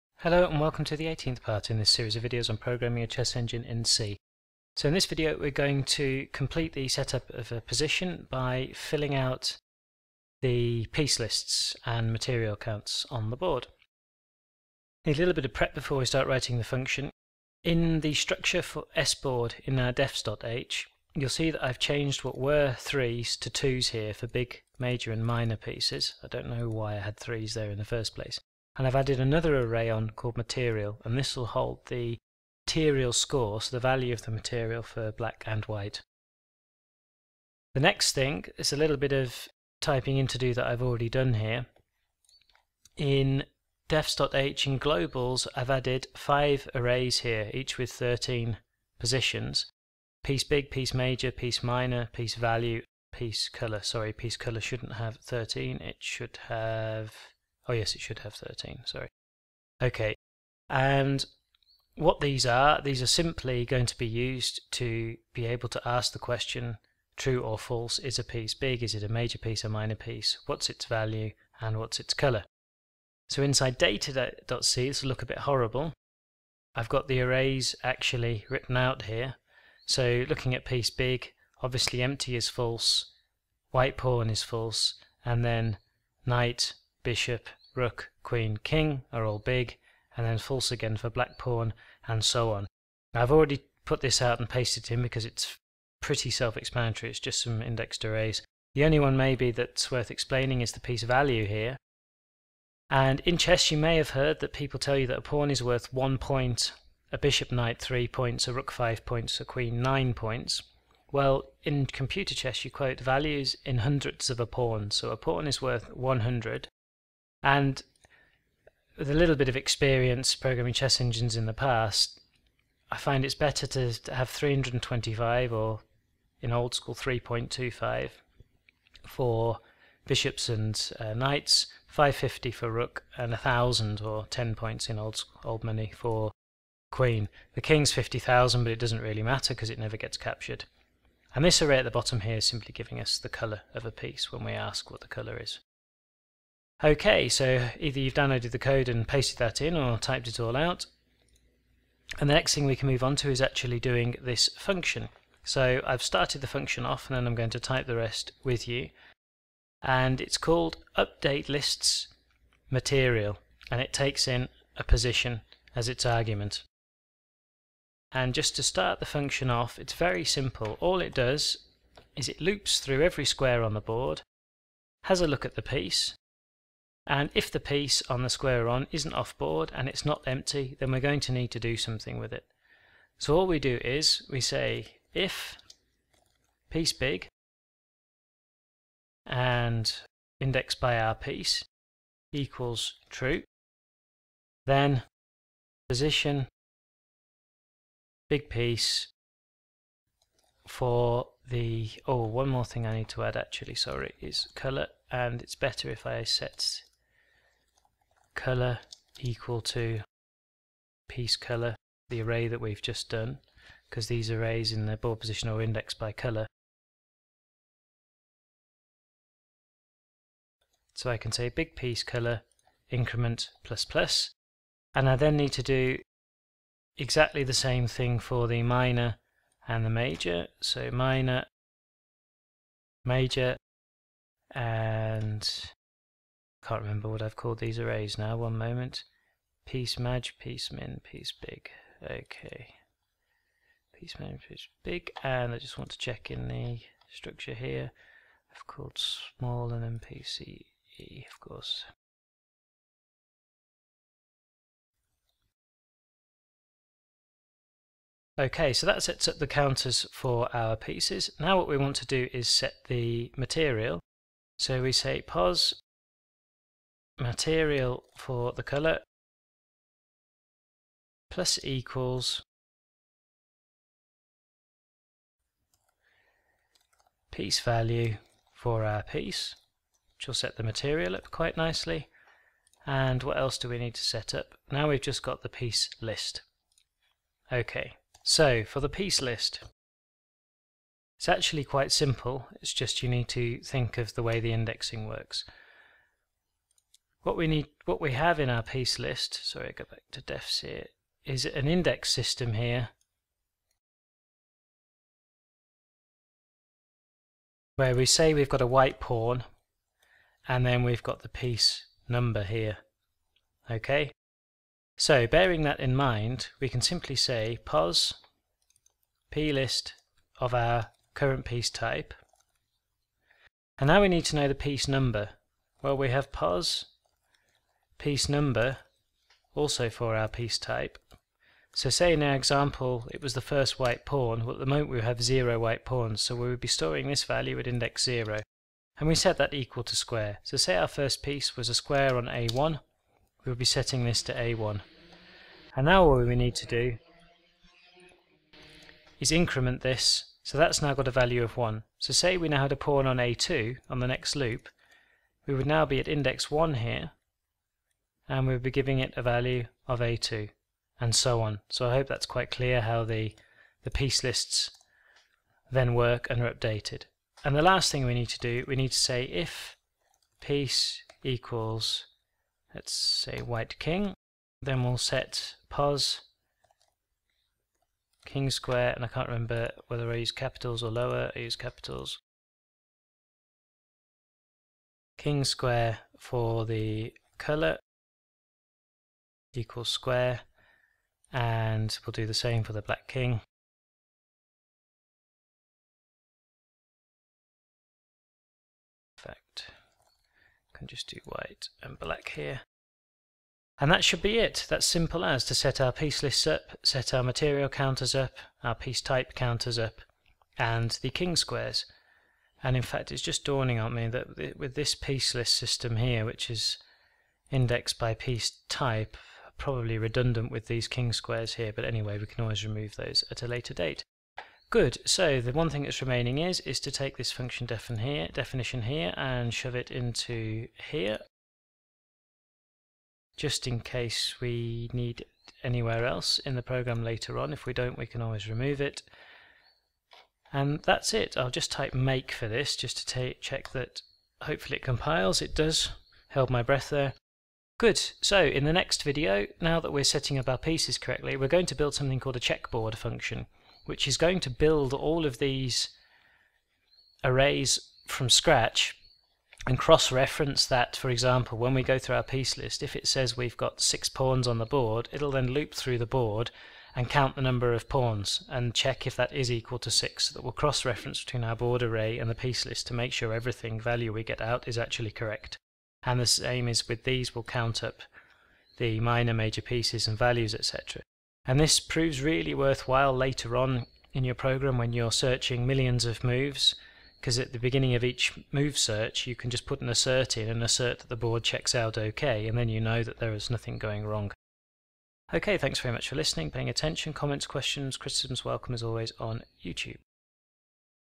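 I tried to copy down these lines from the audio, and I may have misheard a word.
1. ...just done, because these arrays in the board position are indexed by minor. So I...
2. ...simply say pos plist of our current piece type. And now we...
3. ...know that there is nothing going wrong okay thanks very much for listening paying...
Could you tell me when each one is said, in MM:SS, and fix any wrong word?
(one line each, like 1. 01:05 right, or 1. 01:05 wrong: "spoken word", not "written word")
1. 03:32 wrong: "color", not "minor"
2. 05:16 right
3. 08:12 right.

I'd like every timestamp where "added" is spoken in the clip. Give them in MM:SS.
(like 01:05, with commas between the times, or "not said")
00:28, 00:45.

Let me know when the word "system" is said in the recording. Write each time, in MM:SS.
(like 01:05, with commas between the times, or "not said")
05:02, 06:55.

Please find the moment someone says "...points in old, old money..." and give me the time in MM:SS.
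02:14.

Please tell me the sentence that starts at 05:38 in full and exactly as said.
And we set that equal to square.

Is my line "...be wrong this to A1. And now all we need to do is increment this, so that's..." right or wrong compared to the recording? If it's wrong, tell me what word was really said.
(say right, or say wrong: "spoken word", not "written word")
wrong: "setting", not "wrong".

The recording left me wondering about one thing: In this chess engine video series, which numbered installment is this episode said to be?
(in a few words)
18th.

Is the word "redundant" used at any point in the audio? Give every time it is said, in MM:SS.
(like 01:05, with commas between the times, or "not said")
06:59.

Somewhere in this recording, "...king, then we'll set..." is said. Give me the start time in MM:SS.
06:13.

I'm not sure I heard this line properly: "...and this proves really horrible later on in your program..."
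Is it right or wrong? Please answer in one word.
wrong.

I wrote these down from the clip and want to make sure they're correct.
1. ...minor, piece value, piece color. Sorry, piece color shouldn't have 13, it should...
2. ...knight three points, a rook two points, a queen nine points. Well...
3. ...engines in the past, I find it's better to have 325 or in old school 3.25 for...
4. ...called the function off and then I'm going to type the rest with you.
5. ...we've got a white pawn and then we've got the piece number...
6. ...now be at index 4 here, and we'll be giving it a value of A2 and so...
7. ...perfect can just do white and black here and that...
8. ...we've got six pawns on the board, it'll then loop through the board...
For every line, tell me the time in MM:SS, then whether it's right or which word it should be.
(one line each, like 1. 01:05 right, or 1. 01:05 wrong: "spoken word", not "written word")
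1. 00:51 right
2. 01:47 wrong: "five", not "two"
3. 02:01 right
4. 02:36 wrong: "started", not "called"
5. 05:08 right
6. 05:55 wrong: "1", not "4"
7. 06:39 right
8. 07:43 right.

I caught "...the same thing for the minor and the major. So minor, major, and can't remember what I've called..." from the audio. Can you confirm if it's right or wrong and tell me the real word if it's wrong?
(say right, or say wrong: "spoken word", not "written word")
right.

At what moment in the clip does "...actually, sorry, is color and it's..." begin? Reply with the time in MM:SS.
03:23.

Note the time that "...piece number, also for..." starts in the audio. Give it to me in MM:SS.
05:28.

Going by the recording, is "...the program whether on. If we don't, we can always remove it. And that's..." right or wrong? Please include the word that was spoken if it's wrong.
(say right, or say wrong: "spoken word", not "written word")
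wrong: "later", not "whether".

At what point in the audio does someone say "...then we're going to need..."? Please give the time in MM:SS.
03:00.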